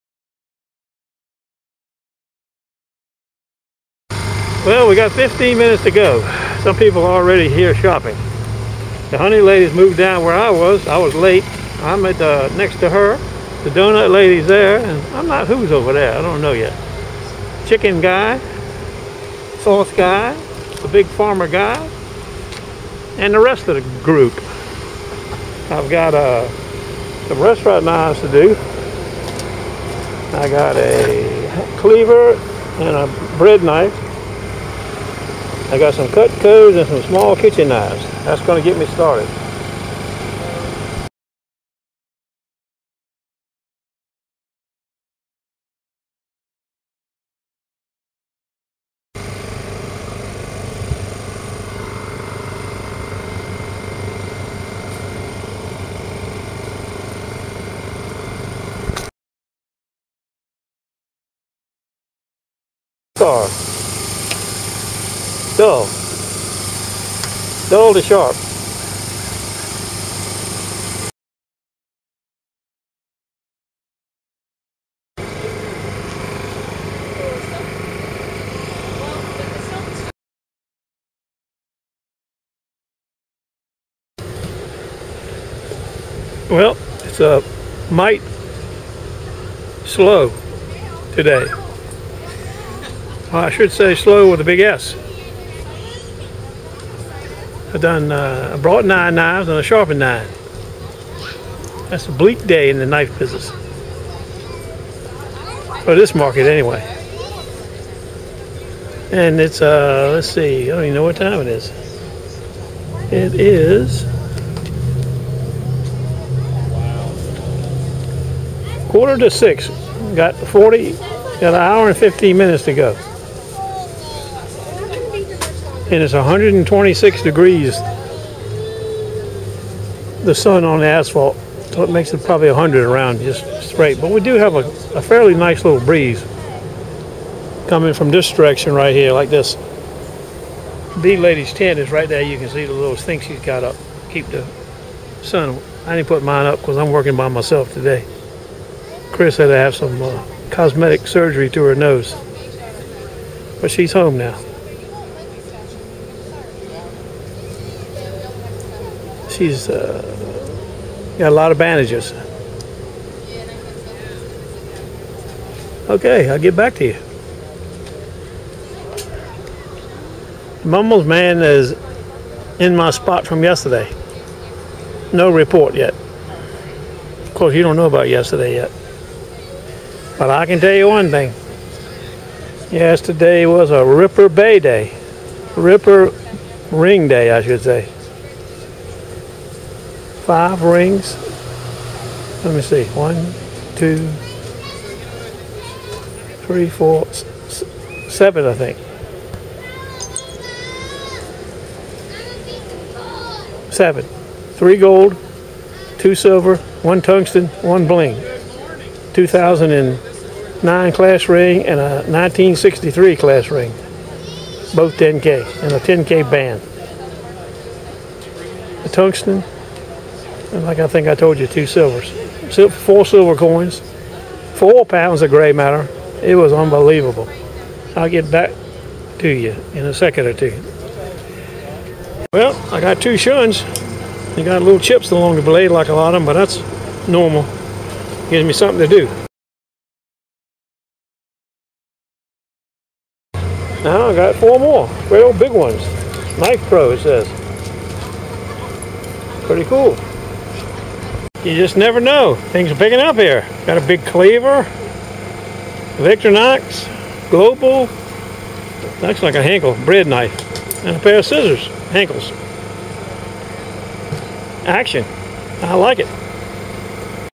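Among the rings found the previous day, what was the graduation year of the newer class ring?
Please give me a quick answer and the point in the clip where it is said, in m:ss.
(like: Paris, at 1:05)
2009, at 3:29.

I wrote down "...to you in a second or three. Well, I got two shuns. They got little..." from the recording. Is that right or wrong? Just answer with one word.
wrong.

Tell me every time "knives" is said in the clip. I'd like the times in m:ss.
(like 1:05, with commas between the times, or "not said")
0:27, 0:37, 1:39.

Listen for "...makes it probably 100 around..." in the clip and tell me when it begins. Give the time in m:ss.
2:11.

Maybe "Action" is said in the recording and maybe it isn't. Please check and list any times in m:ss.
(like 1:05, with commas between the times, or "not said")
4:24.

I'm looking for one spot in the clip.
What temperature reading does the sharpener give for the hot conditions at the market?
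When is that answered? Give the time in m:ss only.
2:06.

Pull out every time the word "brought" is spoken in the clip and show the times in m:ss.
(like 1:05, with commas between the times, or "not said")
1:38.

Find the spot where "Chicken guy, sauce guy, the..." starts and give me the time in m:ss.
0:17.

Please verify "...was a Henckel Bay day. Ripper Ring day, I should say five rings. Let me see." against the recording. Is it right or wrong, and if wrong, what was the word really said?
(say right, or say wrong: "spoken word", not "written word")
wrong: "Ripper", not "Henckel".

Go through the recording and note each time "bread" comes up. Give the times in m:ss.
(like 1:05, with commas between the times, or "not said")
0:33, 4:19.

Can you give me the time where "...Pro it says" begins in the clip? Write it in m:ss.
4:06.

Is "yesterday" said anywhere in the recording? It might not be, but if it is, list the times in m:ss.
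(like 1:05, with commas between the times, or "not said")
2:53, 2:58, 3:02.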